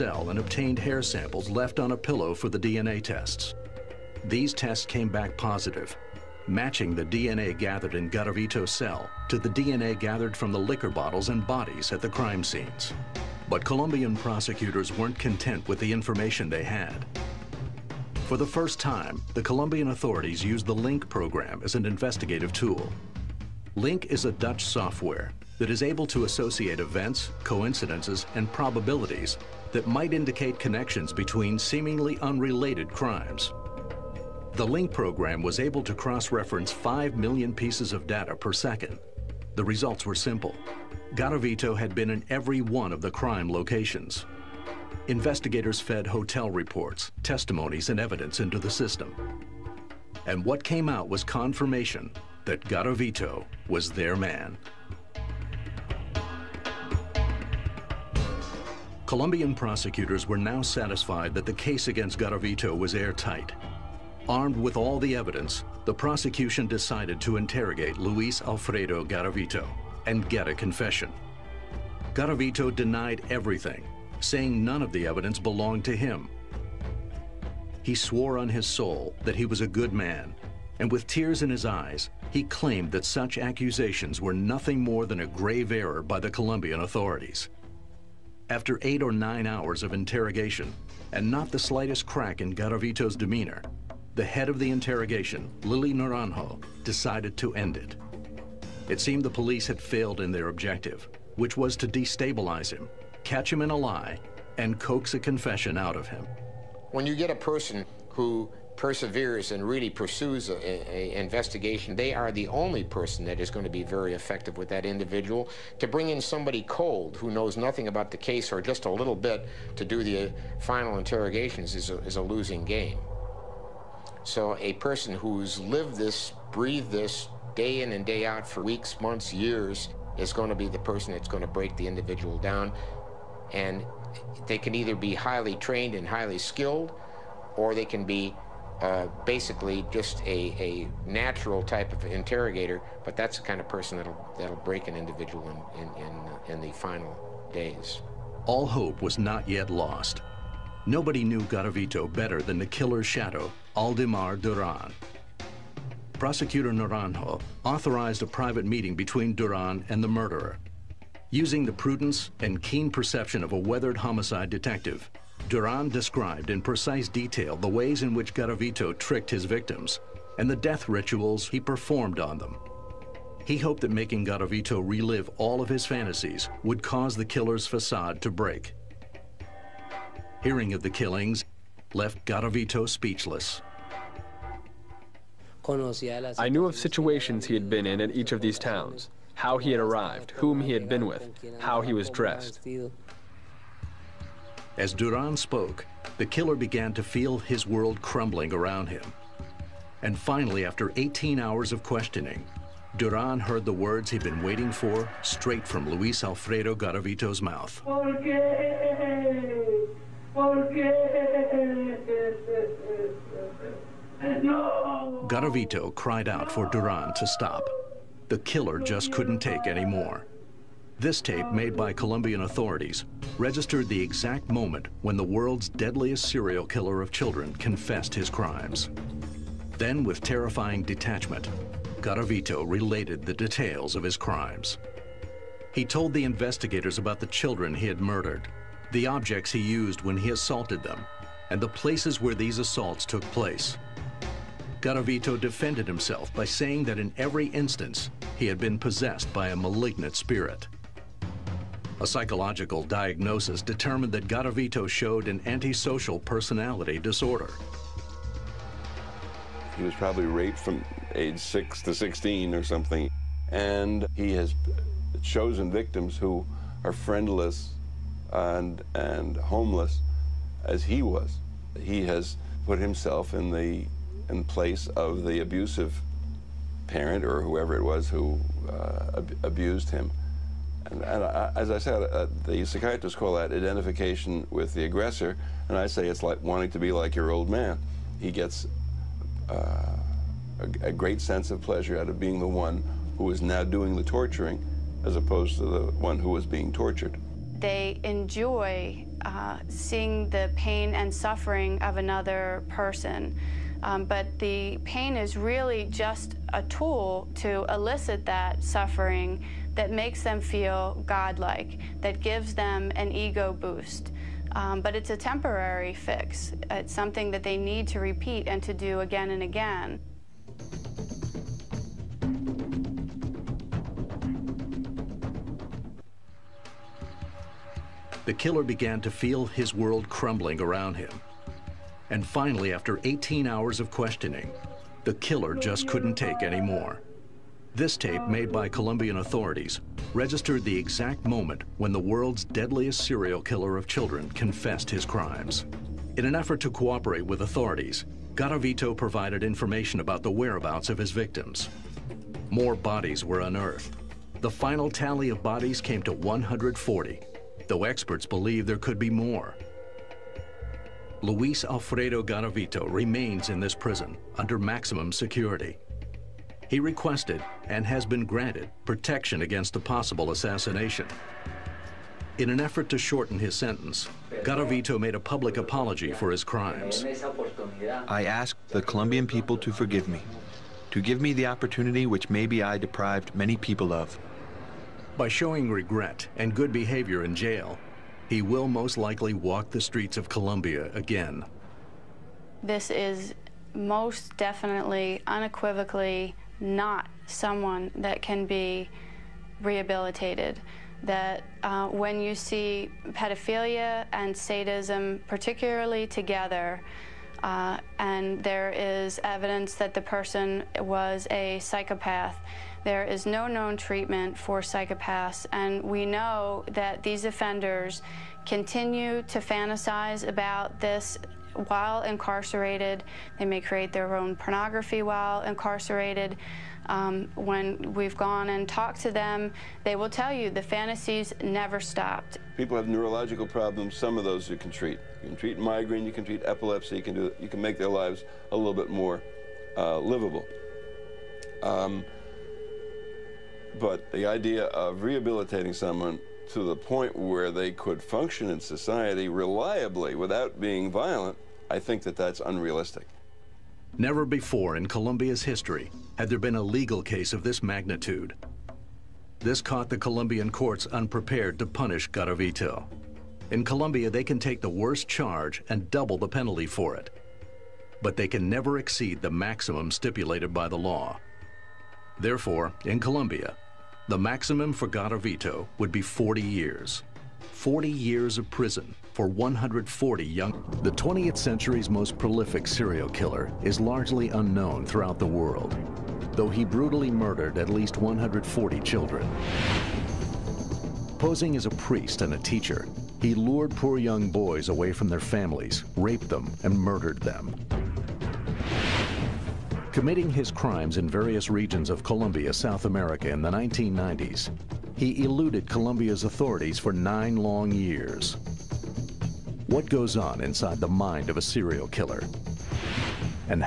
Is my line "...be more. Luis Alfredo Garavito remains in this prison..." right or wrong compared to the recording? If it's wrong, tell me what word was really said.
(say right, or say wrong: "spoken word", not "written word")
right.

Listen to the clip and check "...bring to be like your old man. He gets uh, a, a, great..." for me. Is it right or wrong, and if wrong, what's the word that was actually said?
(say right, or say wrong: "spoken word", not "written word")
wrong: "wanting", not "bring".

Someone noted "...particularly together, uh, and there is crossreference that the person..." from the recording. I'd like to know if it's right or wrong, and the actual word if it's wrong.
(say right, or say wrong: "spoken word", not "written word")
wrong: "evidence", not "crossreference".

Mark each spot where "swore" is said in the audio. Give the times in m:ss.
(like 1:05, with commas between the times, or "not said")
1:17.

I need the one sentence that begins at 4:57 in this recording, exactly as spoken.
They enjoy uh, seeing the pain and suffering of another person.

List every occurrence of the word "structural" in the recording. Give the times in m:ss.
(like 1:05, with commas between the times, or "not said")
not said.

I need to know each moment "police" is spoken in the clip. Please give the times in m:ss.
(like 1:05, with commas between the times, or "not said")
1:39.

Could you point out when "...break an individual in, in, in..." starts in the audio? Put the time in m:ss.
2:24.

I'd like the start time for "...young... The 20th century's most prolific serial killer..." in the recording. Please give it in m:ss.
8:00.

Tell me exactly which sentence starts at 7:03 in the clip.
They may create their own pornography while incarcerated.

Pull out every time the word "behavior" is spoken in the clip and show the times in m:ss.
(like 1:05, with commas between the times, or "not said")
6:26.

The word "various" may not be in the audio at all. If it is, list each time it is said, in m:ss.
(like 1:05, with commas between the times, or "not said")
8:21.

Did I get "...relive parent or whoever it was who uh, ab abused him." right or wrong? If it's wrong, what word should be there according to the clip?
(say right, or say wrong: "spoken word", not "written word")
wrong: "abusive", not "relive".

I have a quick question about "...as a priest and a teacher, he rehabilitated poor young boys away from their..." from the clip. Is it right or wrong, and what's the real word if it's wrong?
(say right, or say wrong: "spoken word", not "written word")
wrong: "lured", not "rehabilitated".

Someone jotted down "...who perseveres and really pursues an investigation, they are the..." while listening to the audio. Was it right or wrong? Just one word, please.
right.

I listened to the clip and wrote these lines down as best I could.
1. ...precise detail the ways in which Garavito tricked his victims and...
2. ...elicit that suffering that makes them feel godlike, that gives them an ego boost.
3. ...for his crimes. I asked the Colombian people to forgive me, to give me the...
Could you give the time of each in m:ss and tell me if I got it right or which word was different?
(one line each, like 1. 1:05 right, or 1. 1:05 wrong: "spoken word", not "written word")
1. 2:46 right
2. 5:07 right
3. 6:16 right.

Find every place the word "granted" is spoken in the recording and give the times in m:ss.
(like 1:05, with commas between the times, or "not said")
6:08.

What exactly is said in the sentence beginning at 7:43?
In Colombia, they can take the worst charge and double the penalty for it.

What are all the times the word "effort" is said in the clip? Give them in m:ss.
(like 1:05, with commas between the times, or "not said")
5:46, 6:12.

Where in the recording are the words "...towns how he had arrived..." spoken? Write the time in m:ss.
3:08.